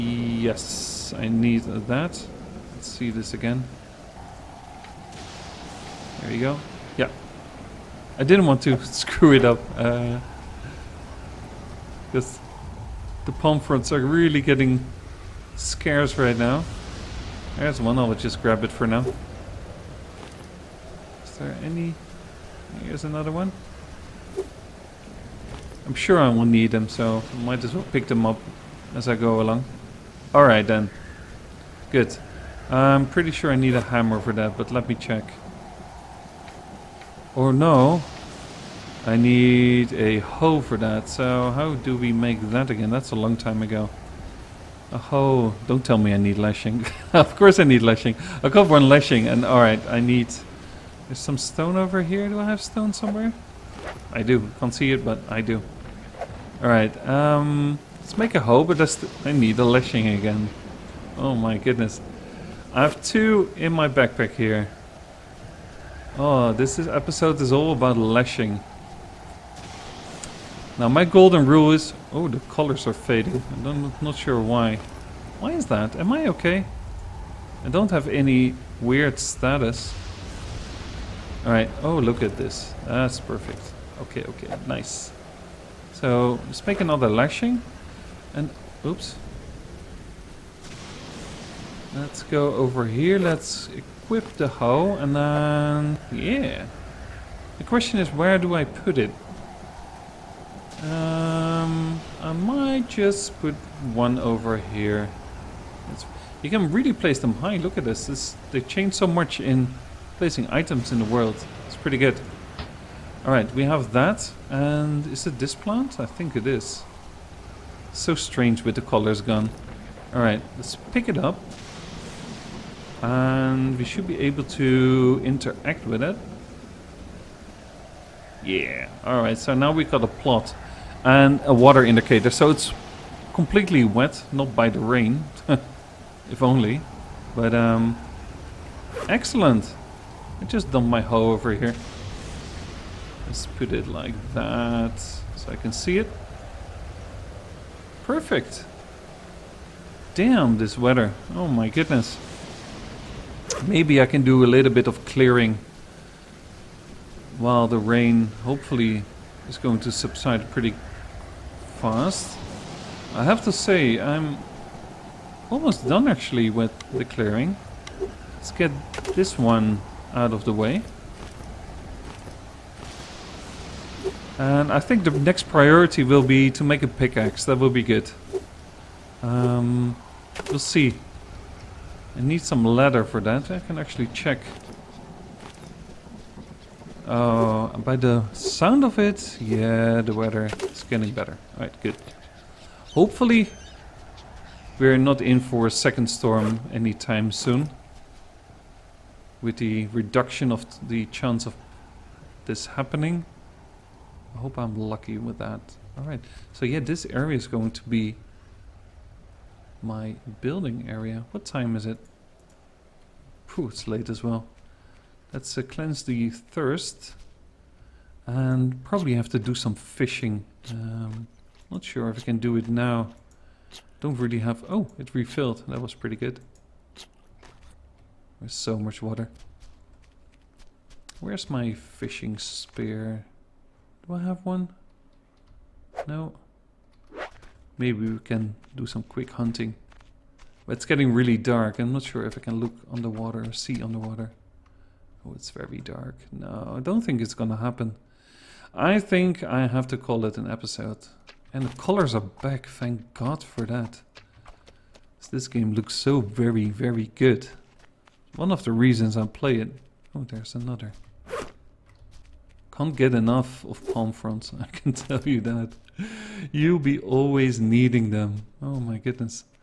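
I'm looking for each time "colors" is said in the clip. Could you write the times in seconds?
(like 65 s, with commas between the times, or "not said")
72 s, 118 s, 251 s.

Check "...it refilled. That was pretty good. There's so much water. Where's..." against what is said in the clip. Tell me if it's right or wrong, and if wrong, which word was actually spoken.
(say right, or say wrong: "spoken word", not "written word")
right.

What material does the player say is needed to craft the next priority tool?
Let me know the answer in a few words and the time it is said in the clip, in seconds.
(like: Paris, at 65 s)
Leather, at 182 s.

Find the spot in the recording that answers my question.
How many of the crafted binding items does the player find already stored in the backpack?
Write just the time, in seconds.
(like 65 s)
62 s.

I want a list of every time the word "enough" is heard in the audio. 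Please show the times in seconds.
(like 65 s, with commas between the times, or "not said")
263 s.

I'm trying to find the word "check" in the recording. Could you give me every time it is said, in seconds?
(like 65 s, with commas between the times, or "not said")
34 s, 184 s.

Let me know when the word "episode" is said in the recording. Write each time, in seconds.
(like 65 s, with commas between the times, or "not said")
66 s, 250 s.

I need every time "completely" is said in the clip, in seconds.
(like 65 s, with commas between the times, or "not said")
133 s.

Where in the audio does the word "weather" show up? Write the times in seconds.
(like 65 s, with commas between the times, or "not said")
150 s, 190 s.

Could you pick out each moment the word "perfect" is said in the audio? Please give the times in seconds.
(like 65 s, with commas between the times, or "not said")
83 s, 148 s.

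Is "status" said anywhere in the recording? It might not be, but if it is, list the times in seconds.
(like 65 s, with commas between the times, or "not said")
79 s.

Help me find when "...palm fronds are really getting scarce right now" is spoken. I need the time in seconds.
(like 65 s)
13 s.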